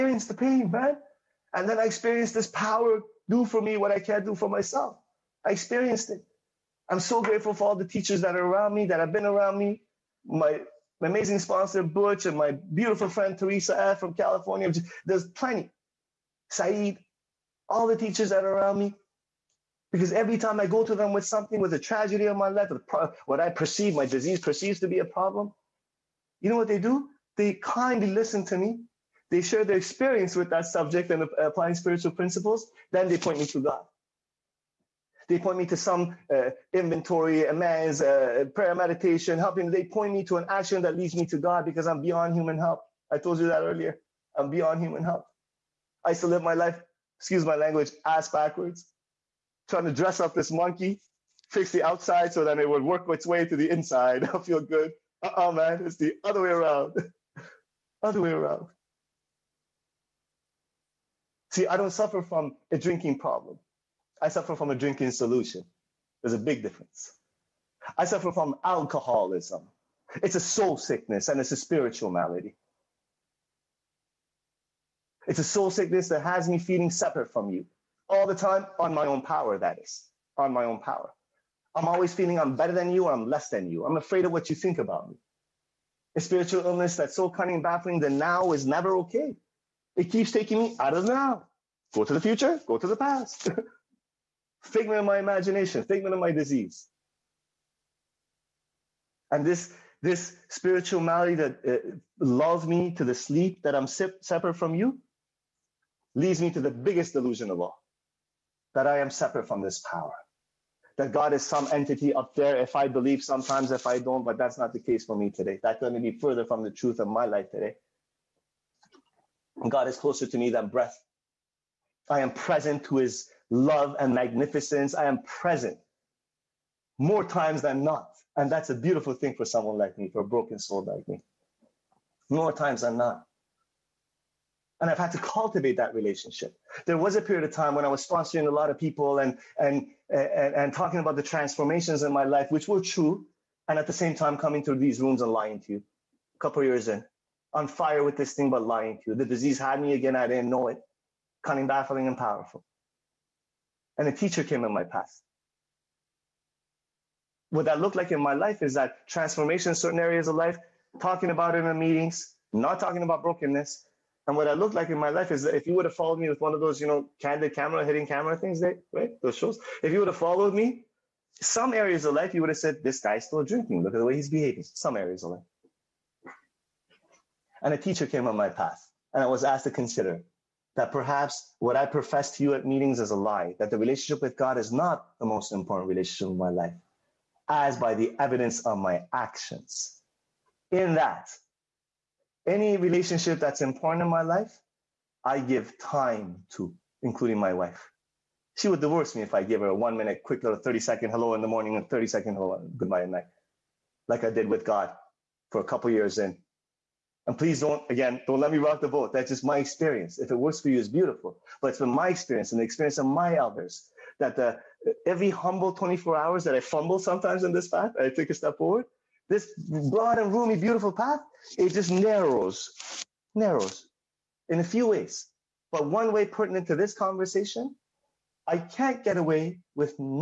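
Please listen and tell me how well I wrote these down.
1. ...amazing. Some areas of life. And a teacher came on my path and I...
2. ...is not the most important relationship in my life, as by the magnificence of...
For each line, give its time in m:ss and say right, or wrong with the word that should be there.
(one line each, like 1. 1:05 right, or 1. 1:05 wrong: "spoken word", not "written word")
1. 2:54 wrong: "behaving", not "amazing"
2. 3:04 wrong: "evidence", not "magnificence".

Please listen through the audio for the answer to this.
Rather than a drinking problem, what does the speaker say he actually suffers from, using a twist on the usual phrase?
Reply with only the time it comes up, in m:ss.
1:04.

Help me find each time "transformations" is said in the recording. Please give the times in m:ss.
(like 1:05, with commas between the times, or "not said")
2:21, 2:39.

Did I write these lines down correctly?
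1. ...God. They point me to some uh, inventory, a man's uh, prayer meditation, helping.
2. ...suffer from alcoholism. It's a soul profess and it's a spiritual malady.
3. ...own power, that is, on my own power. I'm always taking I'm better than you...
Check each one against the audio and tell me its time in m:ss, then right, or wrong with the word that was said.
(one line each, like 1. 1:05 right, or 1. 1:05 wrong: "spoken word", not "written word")
1. 0:33 right
2. 1:08 wrong: "sickness", not "profess"
3. 1:19 wrong: "feeling", not "taking".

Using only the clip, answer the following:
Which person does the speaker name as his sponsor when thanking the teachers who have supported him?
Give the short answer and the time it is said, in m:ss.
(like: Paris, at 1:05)
Butch, at 0:11.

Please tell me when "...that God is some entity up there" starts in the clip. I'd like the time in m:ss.
1:50.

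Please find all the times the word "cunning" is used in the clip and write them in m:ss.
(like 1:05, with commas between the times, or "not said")
1:27, 2:31.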